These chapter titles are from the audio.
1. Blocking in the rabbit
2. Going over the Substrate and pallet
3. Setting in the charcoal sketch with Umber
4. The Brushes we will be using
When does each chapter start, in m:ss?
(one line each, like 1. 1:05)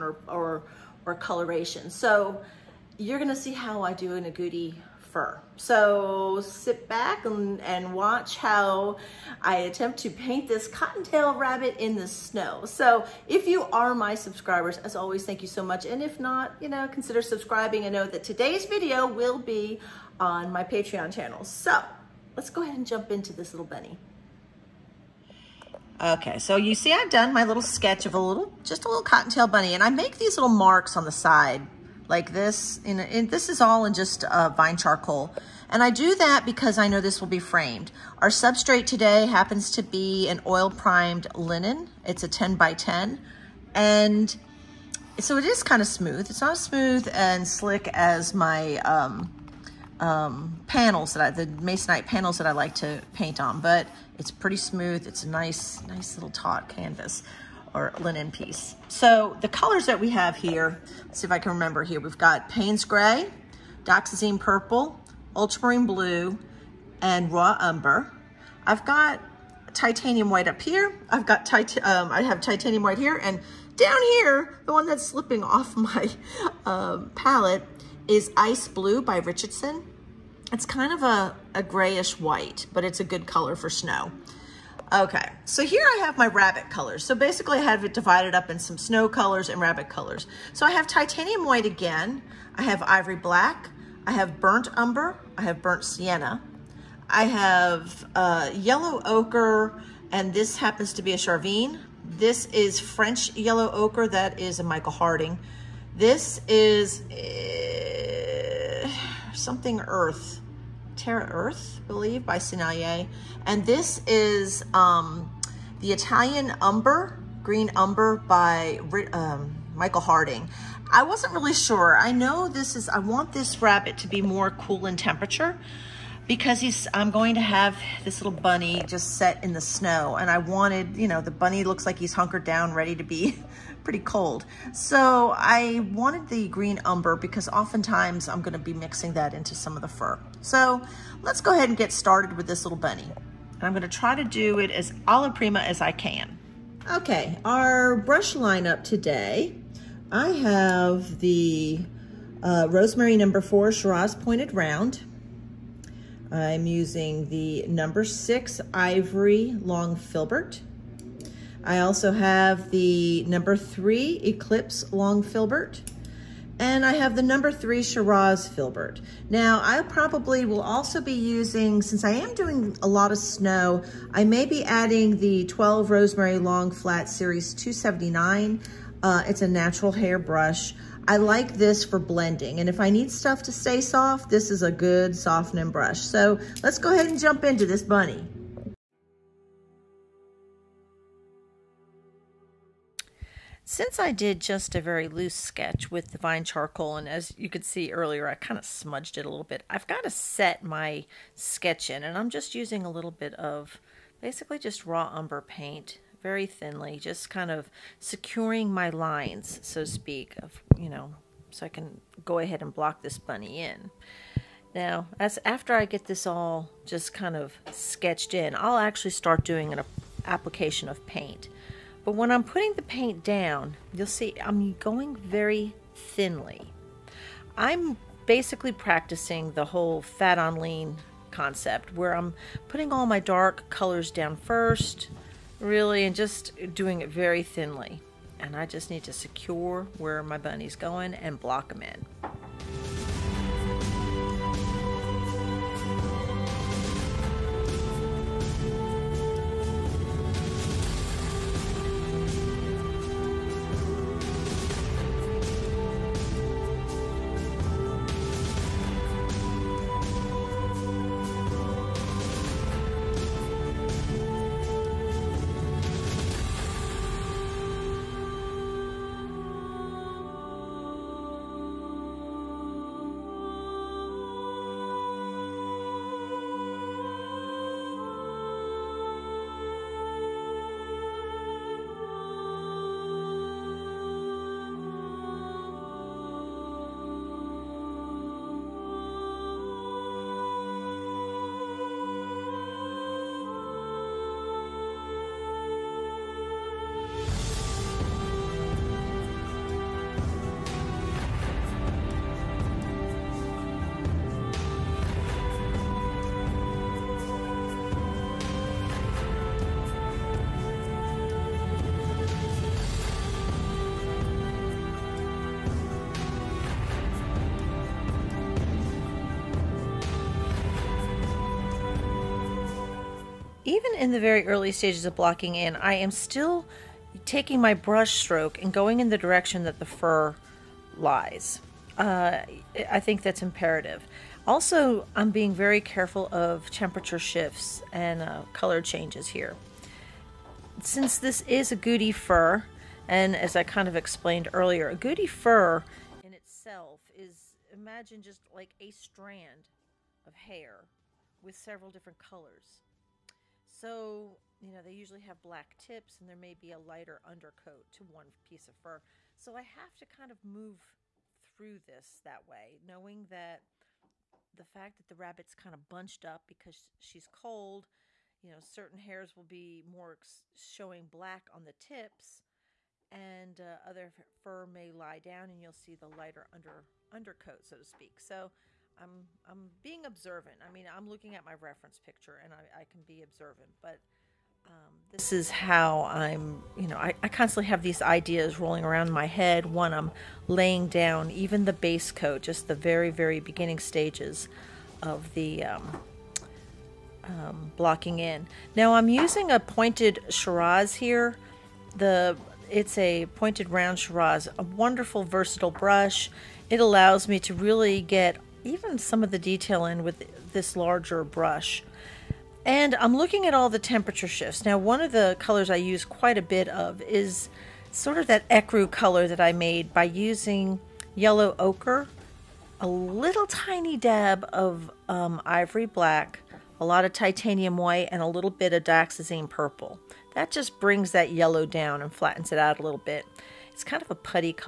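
1. 4:05
2. 0:25
3. 3:08
4. 2:27.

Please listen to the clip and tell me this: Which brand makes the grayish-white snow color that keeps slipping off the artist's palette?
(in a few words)
Richardson.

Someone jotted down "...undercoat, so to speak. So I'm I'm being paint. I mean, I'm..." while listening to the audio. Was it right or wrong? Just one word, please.
wrong.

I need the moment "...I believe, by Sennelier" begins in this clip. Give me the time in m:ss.
1:51.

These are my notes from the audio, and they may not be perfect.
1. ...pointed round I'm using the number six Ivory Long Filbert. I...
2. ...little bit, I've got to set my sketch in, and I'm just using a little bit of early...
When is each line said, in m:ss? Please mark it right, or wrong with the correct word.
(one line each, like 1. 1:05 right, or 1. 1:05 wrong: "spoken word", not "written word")
1. 2:34 right
2. 3:19 wrong: "basically", not "early".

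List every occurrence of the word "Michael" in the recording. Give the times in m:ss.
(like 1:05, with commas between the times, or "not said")
1:44, 1:59.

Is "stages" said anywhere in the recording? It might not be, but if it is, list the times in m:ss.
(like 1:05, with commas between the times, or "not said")
5:24, 6:33.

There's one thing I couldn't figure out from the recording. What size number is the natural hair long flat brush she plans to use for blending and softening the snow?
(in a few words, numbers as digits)
12.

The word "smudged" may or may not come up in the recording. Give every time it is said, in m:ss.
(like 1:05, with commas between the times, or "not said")
3:18.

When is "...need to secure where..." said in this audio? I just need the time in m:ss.
3:58.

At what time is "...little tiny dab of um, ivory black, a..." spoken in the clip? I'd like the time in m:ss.
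7:02.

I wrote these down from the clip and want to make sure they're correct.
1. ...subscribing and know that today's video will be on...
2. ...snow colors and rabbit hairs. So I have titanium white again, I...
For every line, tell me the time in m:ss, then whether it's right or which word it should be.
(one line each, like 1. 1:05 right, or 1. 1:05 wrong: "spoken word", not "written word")
1. 0:17 right
2. 1:28 wrong: "colors", not "hairs".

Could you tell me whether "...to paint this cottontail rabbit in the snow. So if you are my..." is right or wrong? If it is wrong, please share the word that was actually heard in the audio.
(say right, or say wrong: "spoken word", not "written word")
right.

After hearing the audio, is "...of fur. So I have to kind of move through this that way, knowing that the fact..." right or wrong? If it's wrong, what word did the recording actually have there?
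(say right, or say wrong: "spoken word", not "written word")
right.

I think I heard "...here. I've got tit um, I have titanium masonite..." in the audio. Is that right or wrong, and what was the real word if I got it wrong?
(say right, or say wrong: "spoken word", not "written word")
wrong: "white", not "masonite".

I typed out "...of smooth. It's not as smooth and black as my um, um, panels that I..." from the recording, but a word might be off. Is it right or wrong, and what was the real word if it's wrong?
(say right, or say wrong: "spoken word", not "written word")
wrong: "slick", not "black".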